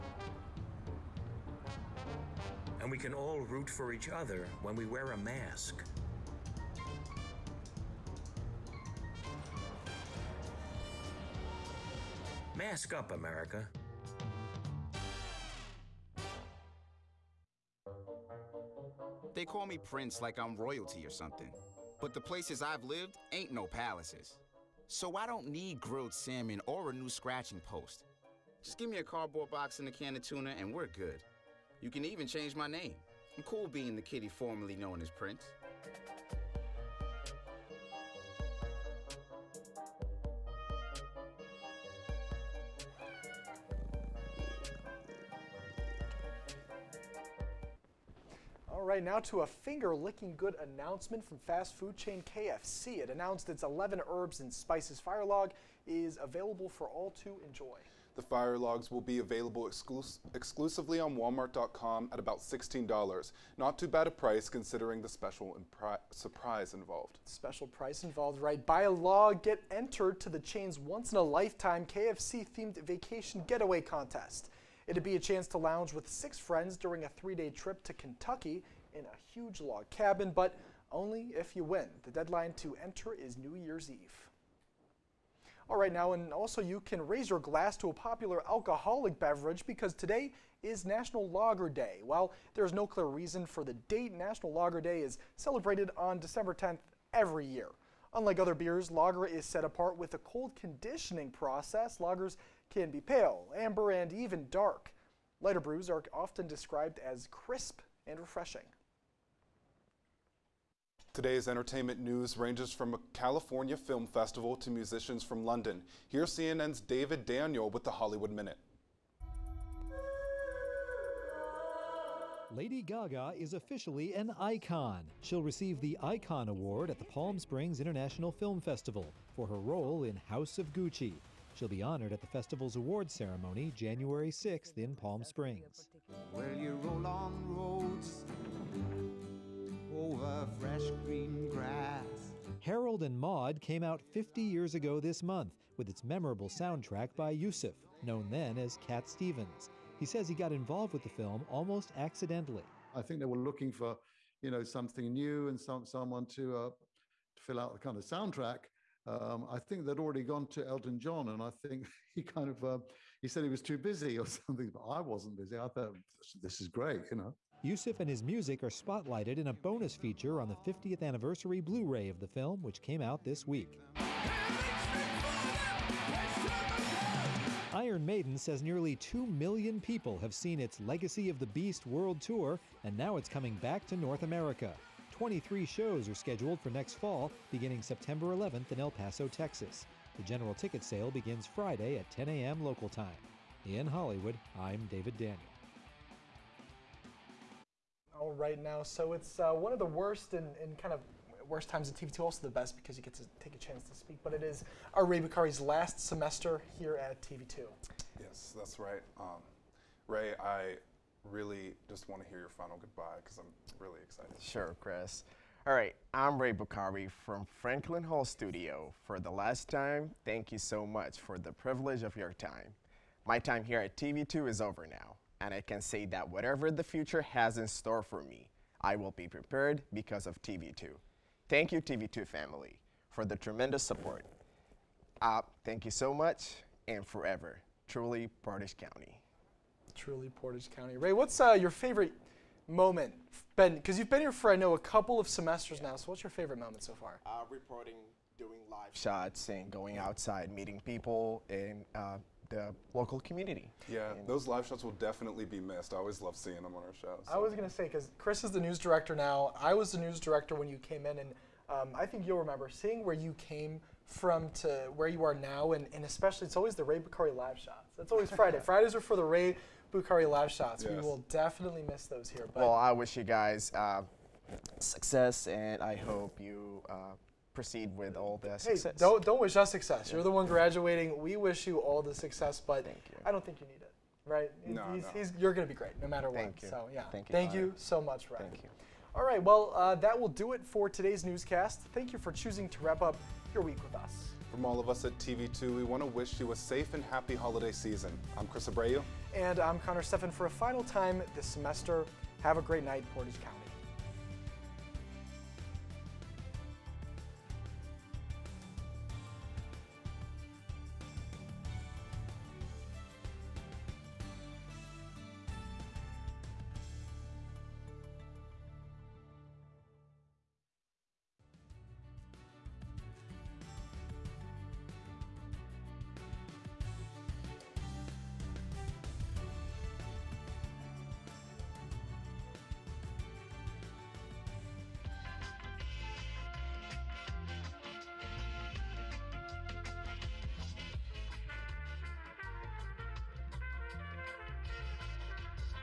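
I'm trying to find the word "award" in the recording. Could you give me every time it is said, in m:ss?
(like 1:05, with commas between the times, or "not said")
2:06, 2:12.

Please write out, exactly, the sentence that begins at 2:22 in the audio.
Harold and Maude came out 50 years ago this month with its memorable soundtrack by Yusuf, known then as Cat Stevens.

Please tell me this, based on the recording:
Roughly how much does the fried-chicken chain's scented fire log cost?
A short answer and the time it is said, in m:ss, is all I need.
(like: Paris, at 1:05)
$16, at 1:02.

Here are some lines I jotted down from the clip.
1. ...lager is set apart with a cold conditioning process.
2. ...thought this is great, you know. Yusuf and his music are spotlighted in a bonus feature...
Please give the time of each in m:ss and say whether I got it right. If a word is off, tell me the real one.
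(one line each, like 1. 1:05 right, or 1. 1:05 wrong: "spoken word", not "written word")
1. 1:38 right
2. 2:45 right.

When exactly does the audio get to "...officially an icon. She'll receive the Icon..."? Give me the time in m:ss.
2:03.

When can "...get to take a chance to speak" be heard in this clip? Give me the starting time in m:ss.
3:23.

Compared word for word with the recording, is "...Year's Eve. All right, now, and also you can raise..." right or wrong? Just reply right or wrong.
right.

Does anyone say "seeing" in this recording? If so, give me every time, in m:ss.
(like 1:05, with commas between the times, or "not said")
4:16, 4:22.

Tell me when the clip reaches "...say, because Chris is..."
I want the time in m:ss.
4:17.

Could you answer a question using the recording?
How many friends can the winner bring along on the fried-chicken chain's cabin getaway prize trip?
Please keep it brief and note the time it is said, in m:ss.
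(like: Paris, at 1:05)
6, at 1:16.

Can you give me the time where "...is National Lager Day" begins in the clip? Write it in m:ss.
1:30.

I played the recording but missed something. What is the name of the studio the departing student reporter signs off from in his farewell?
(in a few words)
Franklin Hall Studio.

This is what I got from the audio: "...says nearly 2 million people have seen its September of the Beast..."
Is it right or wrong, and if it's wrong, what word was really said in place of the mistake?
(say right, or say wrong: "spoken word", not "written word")
wrong: "Legacy", not "September".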